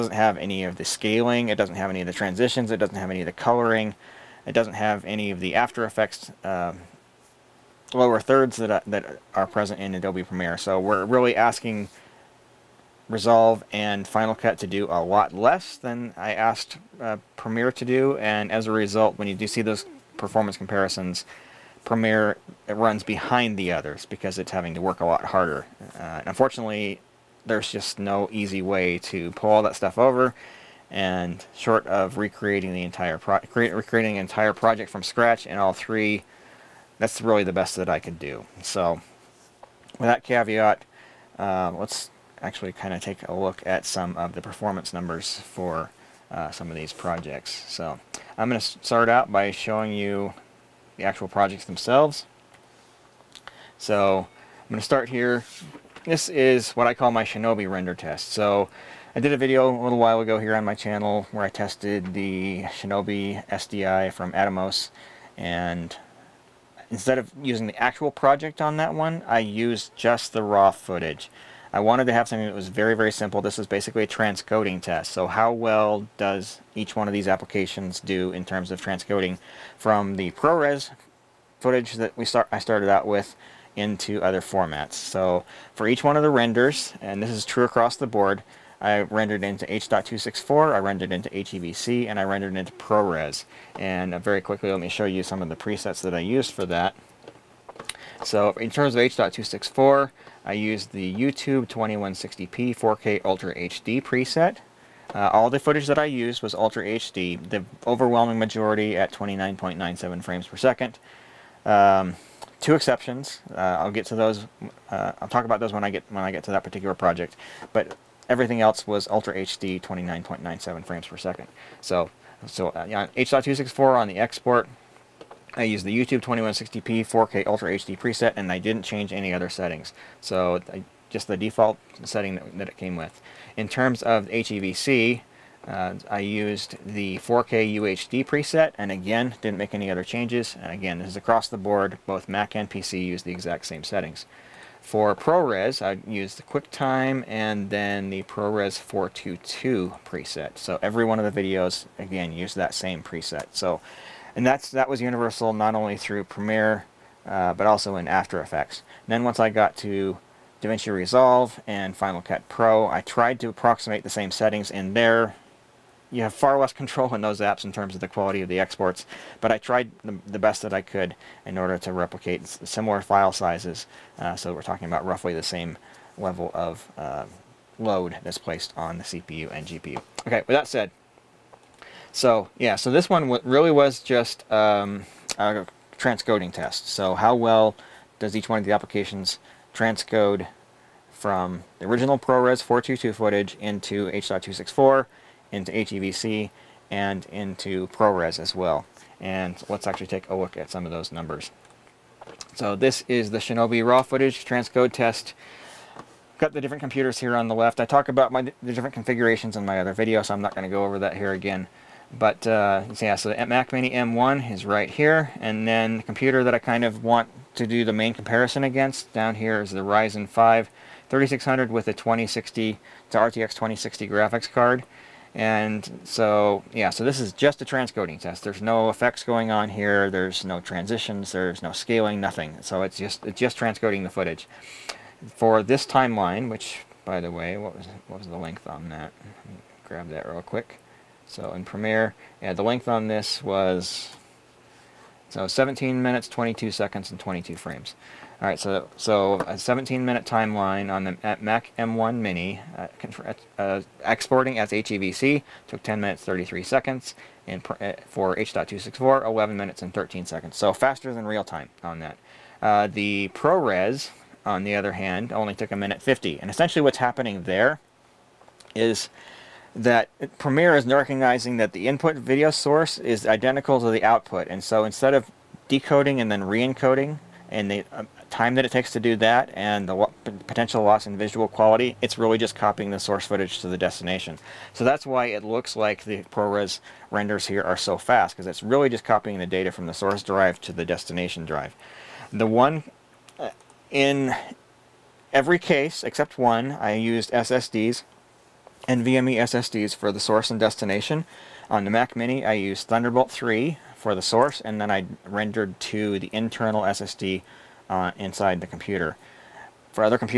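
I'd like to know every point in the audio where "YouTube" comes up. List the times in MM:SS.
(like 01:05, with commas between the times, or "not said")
01:41, 02:05.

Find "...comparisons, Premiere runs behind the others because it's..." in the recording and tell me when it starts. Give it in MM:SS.
00:20.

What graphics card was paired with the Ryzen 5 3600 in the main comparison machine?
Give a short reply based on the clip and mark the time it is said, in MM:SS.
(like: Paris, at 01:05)
RTX 2060, at 03:43.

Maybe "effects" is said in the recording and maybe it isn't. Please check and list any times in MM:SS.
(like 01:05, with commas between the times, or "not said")
00:05, 02:38, 03:48.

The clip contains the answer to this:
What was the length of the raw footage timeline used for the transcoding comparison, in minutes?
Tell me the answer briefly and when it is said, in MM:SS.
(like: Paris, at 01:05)
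17 minutes, at 04:05.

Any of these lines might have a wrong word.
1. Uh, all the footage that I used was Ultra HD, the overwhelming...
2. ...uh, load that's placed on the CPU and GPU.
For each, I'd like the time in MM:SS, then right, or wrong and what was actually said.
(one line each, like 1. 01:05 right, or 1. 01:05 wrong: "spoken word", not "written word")
1. 01:45 right
2. 02:56 right.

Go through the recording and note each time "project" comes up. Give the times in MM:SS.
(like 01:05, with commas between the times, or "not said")
00:34, 00:46, 00:51, 01:08, 01:56.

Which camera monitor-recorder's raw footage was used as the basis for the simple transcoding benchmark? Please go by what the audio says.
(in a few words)
Shinobi SDI.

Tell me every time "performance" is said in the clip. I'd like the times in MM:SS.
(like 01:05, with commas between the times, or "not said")
00:20, 00:44.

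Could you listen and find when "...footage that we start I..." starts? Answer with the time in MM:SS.
01:21.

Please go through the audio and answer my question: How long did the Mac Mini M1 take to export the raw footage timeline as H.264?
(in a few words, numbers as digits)
11 minutes and 13 seconds.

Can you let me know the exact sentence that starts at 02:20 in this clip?
And again, this is across the board.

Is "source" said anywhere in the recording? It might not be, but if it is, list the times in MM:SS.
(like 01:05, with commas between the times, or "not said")
04:32, 04:42, 04:49, 05:00, 05:04.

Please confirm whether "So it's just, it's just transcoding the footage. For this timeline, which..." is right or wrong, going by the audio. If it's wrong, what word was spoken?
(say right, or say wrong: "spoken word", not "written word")
right.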